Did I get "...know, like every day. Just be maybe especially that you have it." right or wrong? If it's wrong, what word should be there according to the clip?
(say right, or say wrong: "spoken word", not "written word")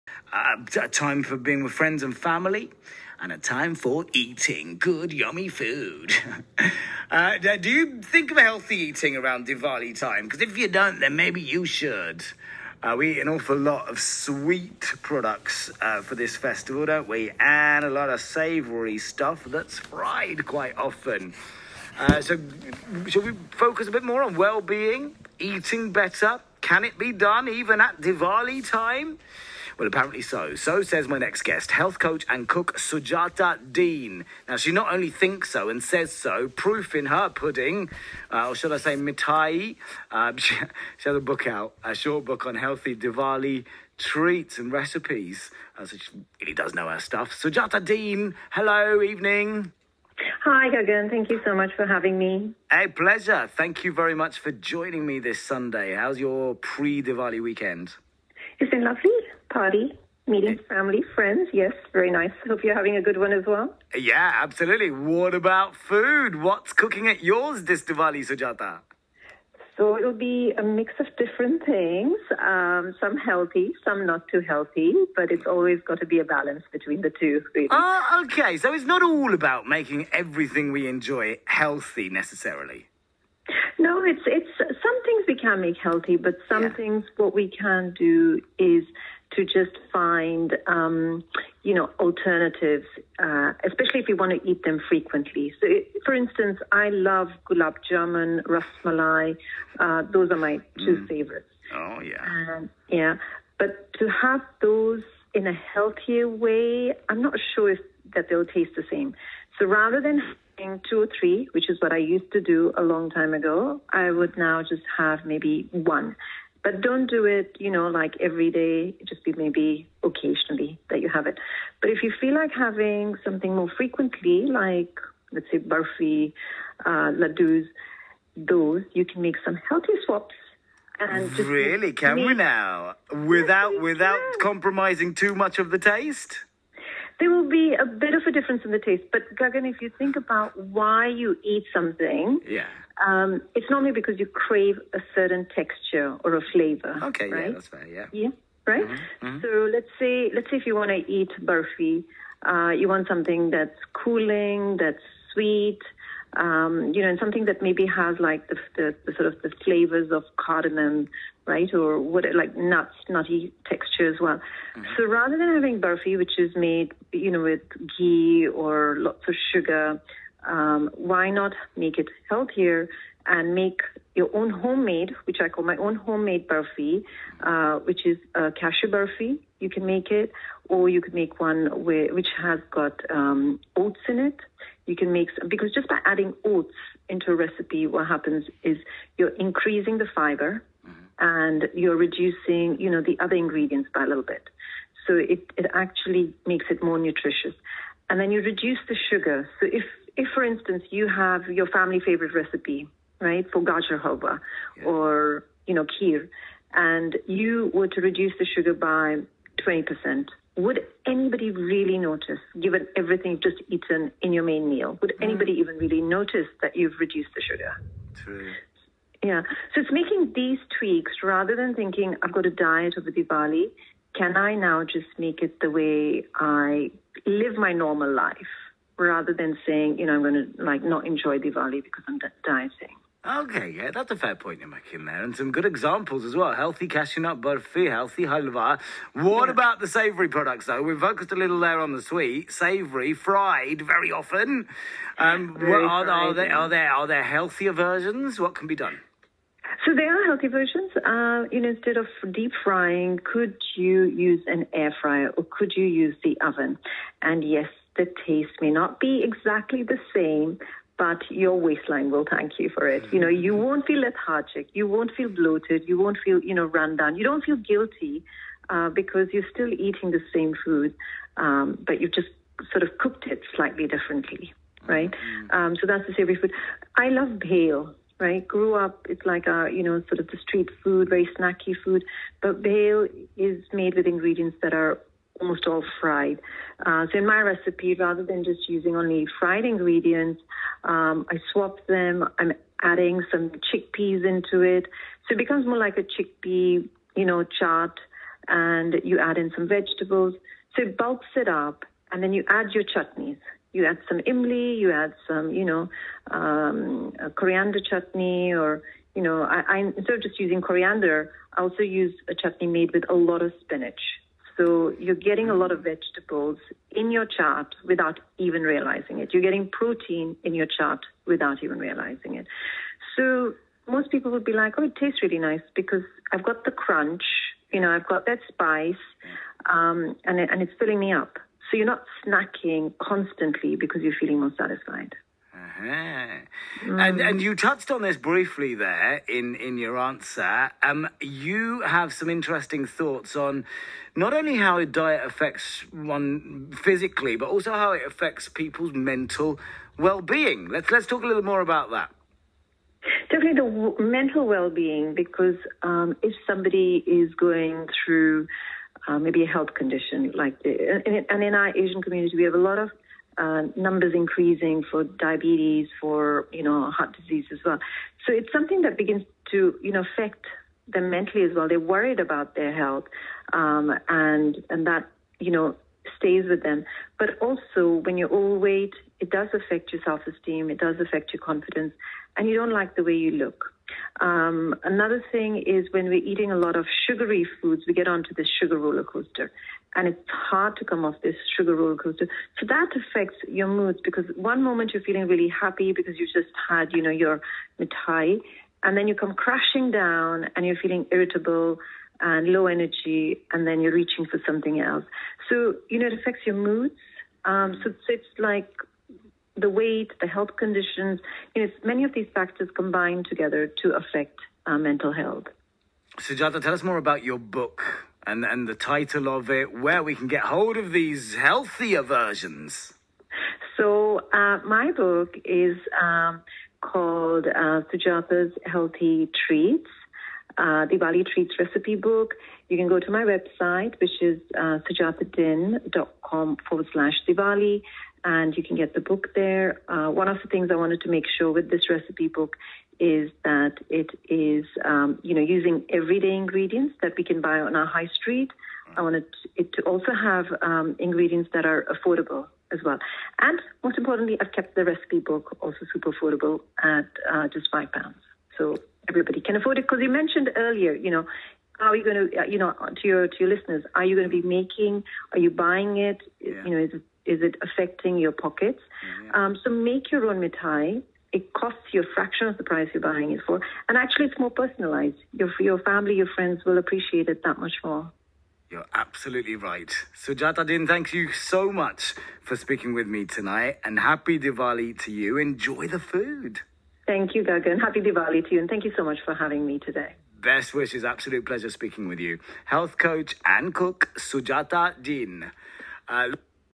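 wrong: "occasionally", not "especially".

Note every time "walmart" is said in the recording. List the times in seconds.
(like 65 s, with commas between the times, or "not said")
not said.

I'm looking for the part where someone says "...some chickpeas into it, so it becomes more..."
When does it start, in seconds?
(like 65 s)
293 s.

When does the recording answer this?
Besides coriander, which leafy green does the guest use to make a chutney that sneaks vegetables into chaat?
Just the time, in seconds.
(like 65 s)
313 s.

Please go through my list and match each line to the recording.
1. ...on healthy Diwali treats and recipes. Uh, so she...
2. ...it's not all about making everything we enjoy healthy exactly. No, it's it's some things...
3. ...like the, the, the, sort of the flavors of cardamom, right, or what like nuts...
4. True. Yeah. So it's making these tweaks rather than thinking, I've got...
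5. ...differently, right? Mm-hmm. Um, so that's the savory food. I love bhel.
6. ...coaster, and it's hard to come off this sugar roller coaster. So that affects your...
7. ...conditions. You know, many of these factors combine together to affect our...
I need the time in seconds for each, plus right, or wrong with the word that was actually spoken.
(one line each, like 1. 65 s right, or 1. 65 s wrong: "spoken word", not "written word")
1. 42 s right
2. 78 s wrong: "necessarily", not "exactly"
3. 158 s right
4. 218 s right
5. 273 s right
6. 389 s right
7. 410 s right.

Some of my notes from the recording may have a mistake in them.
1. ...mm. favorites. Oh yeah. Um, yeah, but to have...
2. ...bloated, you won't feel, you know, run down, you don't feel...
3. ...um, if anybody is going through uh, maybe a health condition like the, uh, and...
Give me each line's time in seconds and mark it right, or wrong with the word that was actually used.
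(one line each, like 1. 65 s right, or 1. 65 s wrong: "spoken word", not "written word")
1. 100 s right
2. 265 s right
3. 355 s wrong: "somebody", not "anybody".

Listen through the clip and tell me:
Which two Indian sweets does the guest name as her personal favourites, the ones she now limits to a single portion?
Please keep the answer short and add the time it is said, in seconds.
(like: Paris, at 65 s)
gulab jamun, ras malai, at 97 s.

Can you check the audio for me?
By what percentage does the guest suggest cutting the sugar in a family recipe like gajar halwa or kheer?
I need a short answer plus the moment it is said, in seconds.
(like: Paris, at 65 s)
20%, at 209 s.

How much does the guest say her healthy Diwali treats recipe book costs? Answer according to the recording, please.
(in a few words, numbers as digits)
5 pounds.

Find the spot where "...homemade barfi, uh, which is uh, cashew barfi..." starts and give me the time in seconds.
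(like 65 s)
175 s.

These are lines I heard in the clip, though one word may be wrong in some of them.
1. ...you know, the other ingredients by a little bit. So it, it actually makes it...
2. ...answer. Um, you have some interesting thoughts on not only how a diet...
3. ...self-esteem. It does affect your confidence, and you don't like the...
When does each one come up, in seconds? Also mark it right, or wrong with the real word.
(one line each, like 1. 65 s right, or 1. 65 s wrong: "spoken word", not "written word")
1. 192 s right
2. 339 s right
3. 380 s right.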